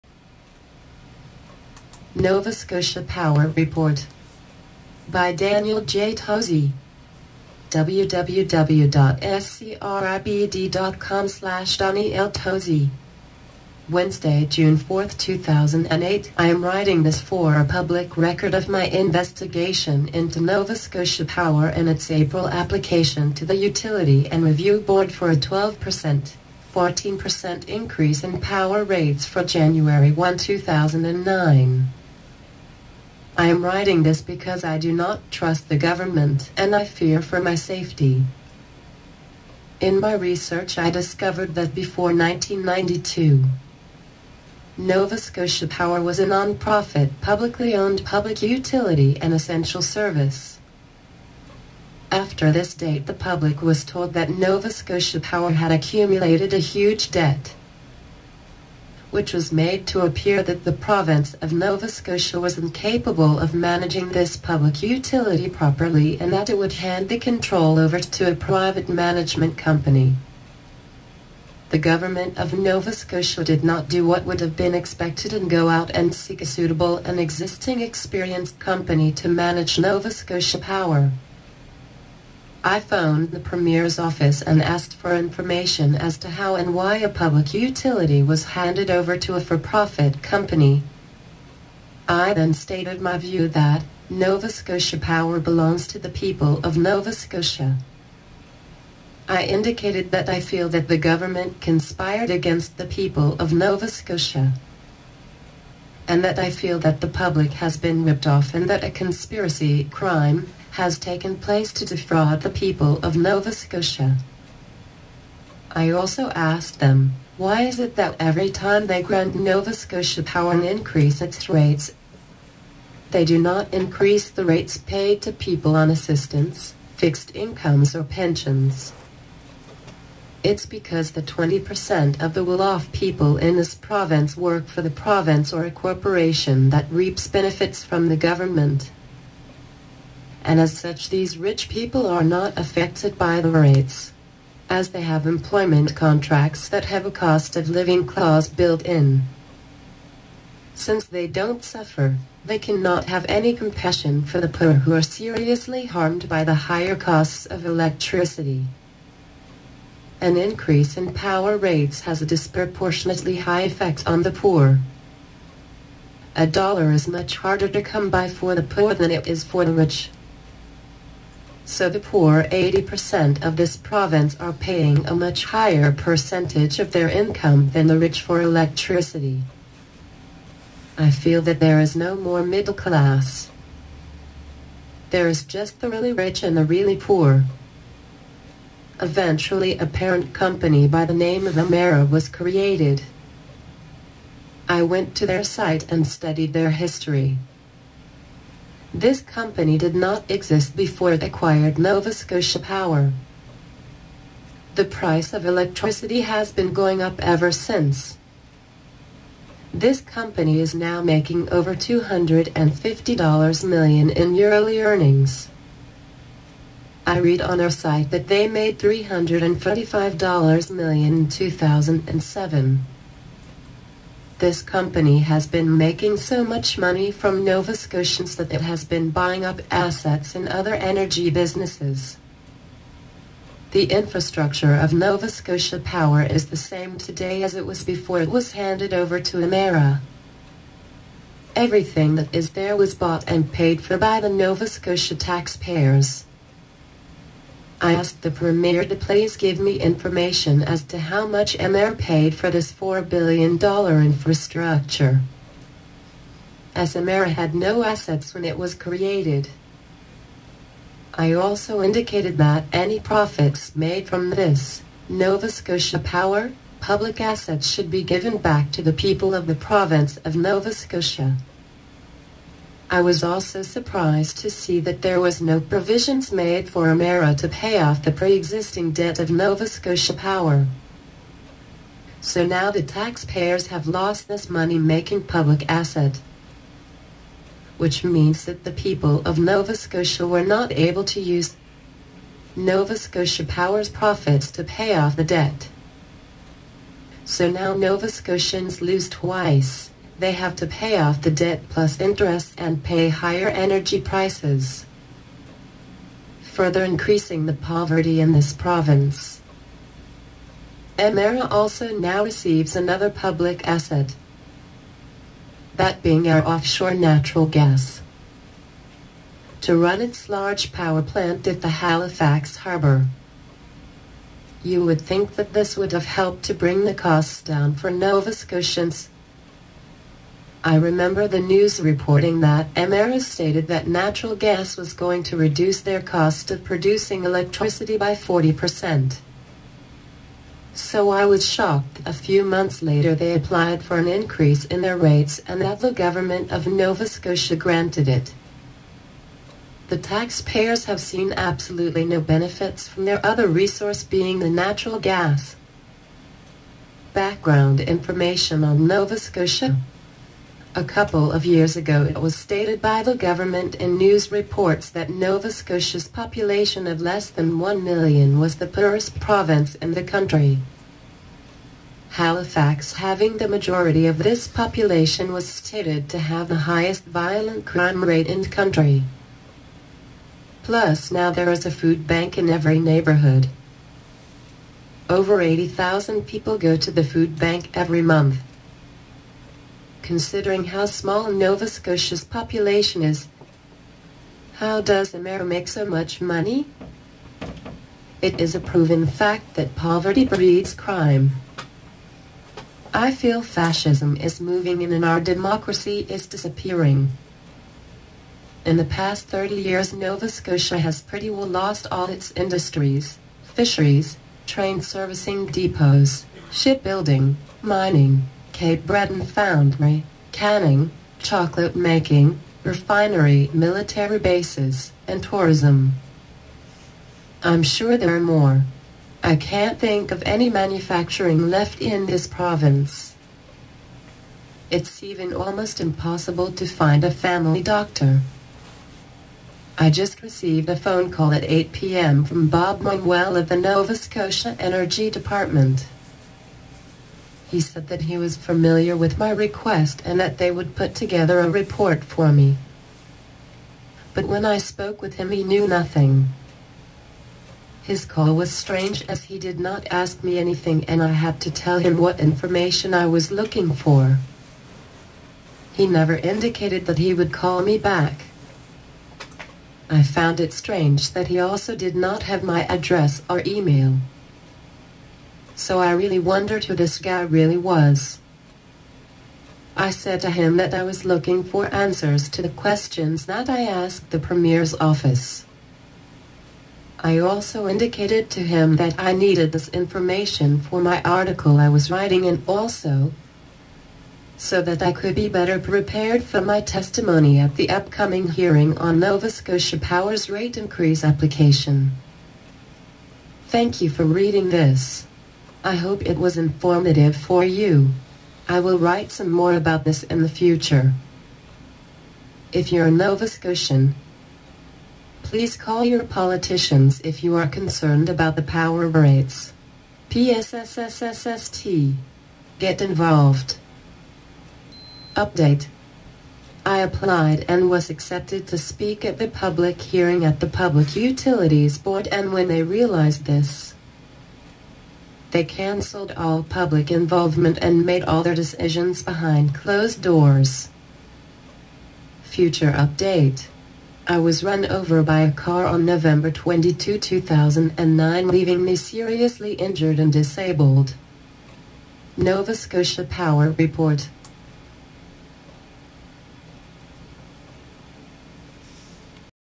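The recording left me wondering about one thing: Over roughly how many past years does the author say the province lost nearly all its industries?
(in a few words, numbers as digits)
30.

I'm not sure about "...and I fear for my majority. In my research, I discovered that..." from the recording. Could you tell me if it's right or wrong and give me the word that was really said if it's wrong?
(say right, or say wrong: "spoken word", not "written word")
wrong: "safety", not "majority".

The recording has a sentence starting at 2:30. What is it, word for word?
Since they don't suffer, they cannot have any compassion for the poor who are seriously harmed by the higher costs of electricity.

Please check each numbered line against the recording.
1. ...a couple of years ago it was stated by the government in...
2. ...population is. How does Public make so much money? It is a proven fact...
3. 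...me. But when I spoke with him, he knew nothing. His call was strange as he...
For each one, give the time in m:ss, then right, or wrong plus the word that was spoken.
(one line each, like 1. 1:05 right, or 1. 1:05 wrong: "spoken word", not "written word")
1. 6:00 right
2. 6:32 wrong: "Emera", not "Public"
3. 7:32 right.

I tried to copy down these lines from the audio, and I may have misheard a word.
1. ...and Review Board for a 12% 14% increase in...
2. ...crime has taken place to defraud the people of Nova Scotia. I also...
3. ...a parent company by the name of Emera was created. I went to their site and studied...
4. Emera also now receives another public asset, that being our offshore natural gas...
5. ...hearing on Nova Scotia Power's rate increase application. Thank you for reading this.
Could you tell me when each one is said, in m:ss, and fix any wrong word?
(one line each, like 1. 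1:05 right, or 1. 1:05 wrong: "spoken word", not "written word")
1. 0:24 right
2. 1:49 right
3. 3:09 right
4. 5:10 right
5. 8:18 right.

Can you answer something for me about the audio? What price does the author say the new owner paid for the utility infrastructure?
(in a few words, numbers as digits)
$4 billion.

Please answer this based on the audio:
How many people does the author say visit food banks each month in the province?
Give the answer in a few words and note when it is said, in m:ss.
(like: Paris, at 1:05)
80,000, at 6:25.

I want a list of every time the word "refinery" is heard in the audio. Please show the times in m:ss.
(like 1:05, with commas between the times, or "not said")
7:02.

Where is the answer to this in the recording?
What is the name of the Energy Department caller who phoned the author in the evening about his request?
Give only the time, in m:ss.
7:22.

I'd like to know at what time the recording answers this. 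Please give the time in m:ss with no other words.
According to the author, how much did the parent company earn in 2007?
3:38.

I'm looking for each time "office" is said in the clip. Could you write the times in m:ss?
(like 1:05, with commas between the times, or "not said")
1:23, 8:04.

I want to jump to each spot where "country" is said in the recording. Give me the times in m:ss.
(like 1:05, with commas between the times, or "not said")
6:10, 6:18.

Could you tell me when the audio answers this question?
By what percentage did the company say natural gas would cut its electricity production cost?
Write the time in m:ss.
5:38.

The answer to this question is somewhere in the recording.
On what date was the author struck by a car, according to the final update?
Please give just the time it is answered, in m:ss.
9:05.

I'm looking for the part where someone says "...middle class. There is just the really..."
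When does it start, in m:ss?
3:02.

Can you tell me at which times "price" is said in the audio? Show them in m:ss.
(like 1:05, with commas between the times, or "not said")
3:24, 5:03.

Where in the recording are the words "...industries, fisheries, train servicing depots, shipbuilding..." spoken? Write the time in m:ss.
6:52.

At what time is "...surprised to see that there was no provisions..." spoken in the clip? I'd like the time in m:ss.
4:33.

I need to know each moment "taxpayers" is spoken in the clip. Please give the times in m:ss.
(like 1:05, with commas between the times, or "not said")
4:05, 4:42, 5:49.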